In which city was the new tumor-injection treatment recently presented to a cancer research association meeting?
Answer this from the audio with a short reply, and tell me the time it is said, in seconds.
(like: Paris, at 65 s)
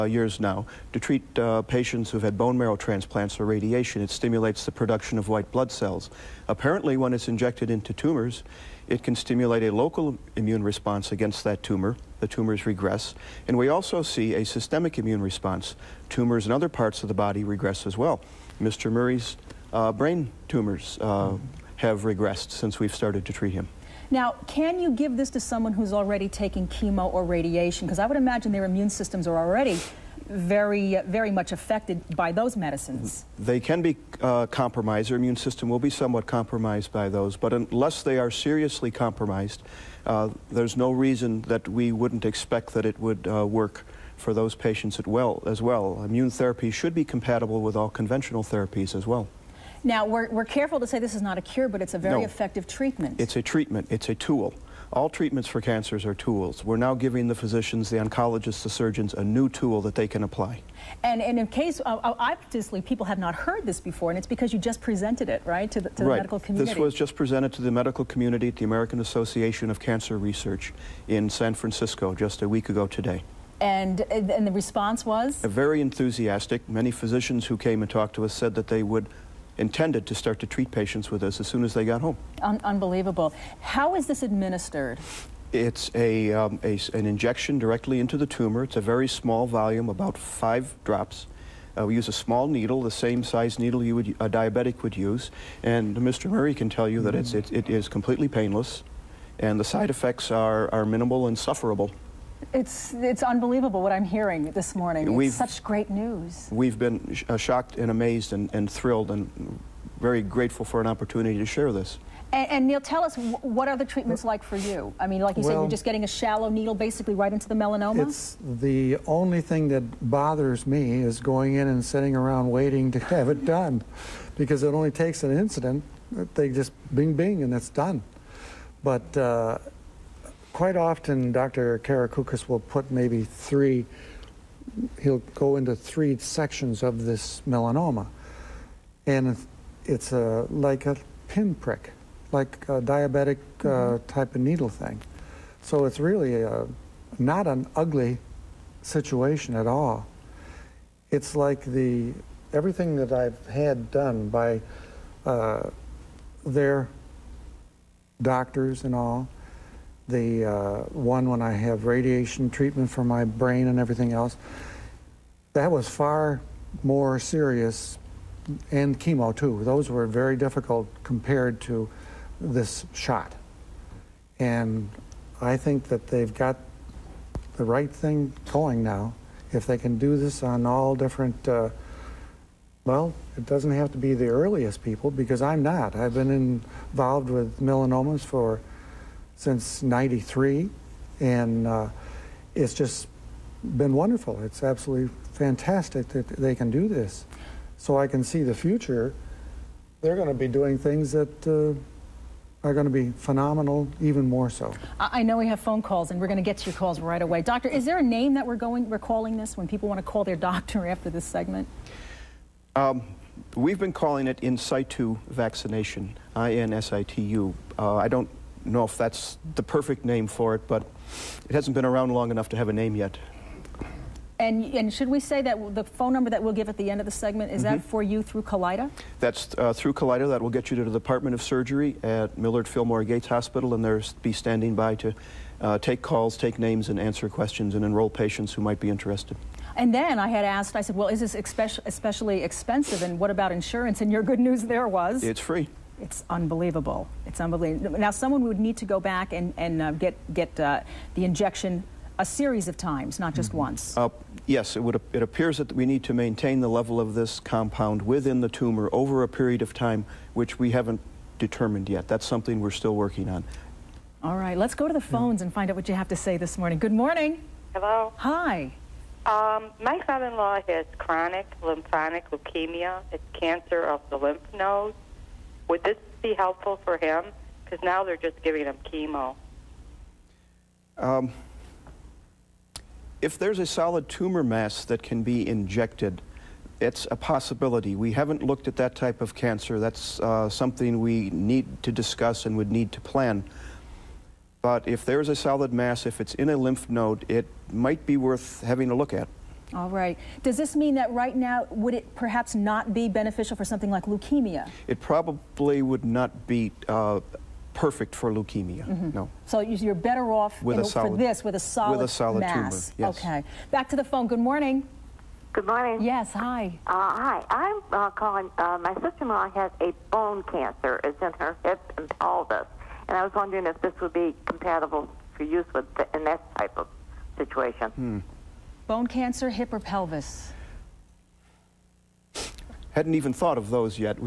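San Francisco, at 71 s.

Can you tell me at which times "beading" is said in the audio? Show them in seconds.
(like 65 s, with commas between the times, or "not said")
not said.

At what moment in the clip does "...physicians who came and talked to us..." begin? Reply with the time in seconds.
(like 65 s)
76 s.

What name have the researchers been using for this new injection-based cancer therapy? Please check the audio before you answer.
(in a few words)
in situ vaccination.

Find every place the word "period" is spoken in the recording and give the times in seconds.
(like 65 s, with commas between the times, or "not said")
259 s.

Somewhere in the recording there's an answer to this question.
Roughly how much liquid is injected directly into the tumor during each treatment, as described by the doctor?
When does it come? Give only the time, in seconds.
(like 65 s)
89 s.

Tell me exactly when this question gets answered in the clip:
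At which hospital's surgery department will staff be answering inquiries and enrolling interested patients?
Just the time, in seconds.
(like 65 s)
232 s.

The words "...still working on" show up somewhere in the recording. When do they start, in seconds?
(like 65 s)
262 s.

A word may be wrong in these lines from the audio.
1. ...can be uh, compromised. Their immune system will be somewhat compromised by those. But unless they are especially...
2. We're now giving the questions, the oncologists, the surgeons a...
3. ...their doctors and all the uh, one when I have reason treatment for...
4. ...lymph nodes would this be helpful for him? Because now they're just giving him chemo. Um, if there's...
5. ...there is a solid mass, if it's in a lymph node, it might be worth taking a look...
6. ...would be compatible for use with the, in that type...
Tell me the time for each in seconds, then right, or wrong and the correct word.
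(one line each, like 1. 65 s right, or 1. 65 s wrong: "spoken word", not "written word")
1. 33 s wrong: "seriously", not "especially"
2. 56 s wrong: "physicians", not "questions"
3. 156 s wrong: "radiation", not "reason"
4. 274 s right
5. 295 s wrong: "having", not "taking"
6. 324 s right.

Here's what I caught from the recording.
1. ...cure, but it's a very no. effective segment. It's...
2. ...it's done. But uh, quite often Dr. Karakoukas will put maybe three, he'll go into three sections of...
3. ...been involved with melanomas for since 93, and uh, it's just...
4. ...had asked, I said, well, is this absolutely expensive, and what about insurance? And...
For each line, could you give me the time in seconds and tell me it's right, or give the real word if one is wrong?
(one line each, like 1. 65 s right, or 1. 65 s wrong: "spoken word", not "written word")
1. 51 s wrong: "treatment", not "segment"
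2. 127 s right
3. 186 s right
4. 240 s wrong: "especially", not "absolutely".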